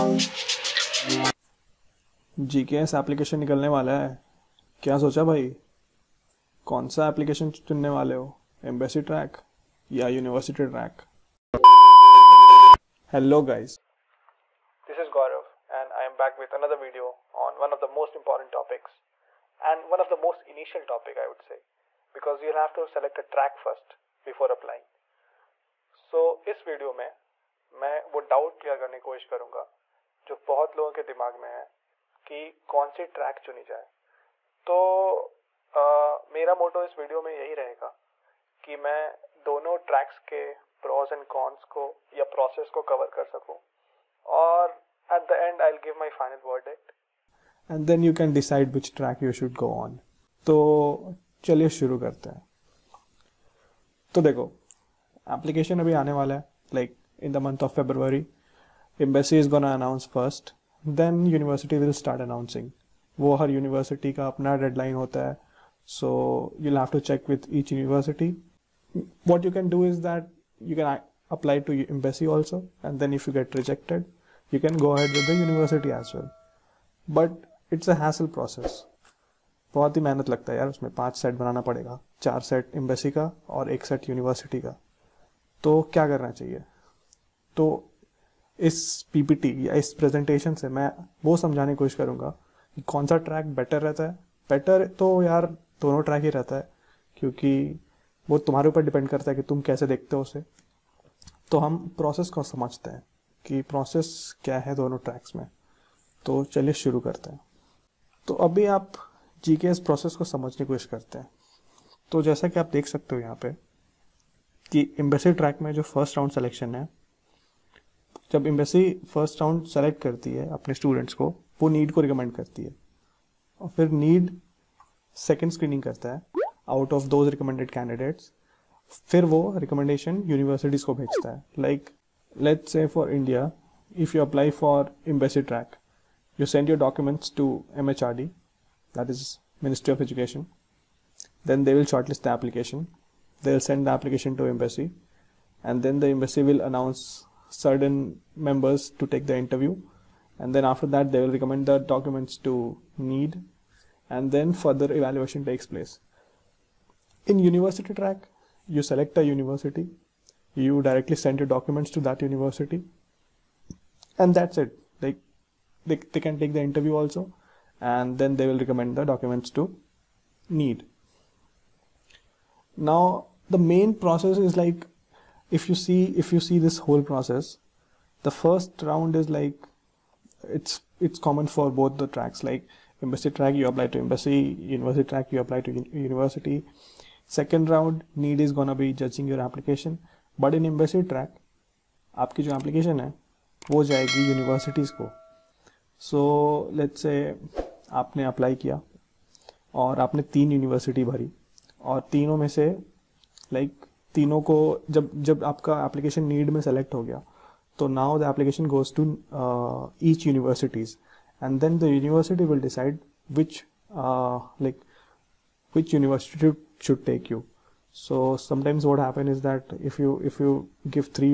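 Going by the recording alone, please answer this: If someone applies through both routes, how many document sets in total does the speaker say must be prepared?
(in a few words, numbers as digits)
5.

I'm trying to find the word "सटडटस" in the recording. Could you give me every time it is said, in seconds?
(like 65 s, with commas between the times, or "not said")
120 s.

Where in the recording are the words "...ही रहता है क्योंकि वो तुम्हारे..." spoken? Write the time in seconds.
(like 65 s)
96 s.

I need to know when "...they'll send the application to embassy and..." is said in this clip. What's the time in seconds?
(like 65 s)
143 s.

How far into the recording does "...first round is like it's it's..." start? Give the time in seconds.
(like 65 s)
178 s.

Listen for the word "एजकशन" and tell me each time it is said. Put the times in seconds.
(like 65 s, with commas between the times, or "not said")
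140 s.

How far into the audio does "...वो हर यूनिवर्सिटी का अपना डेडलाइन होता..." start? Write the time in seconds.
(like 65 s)
63 s.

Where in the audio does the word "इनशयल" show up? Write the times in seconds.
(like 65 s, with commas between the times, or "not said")
20 s.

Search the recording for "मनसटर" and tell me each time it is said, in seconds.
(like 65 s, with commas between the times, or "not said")
139 s.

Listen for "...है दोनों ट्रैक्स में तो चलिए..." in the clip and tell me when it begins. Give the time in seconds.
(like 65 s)
104 s.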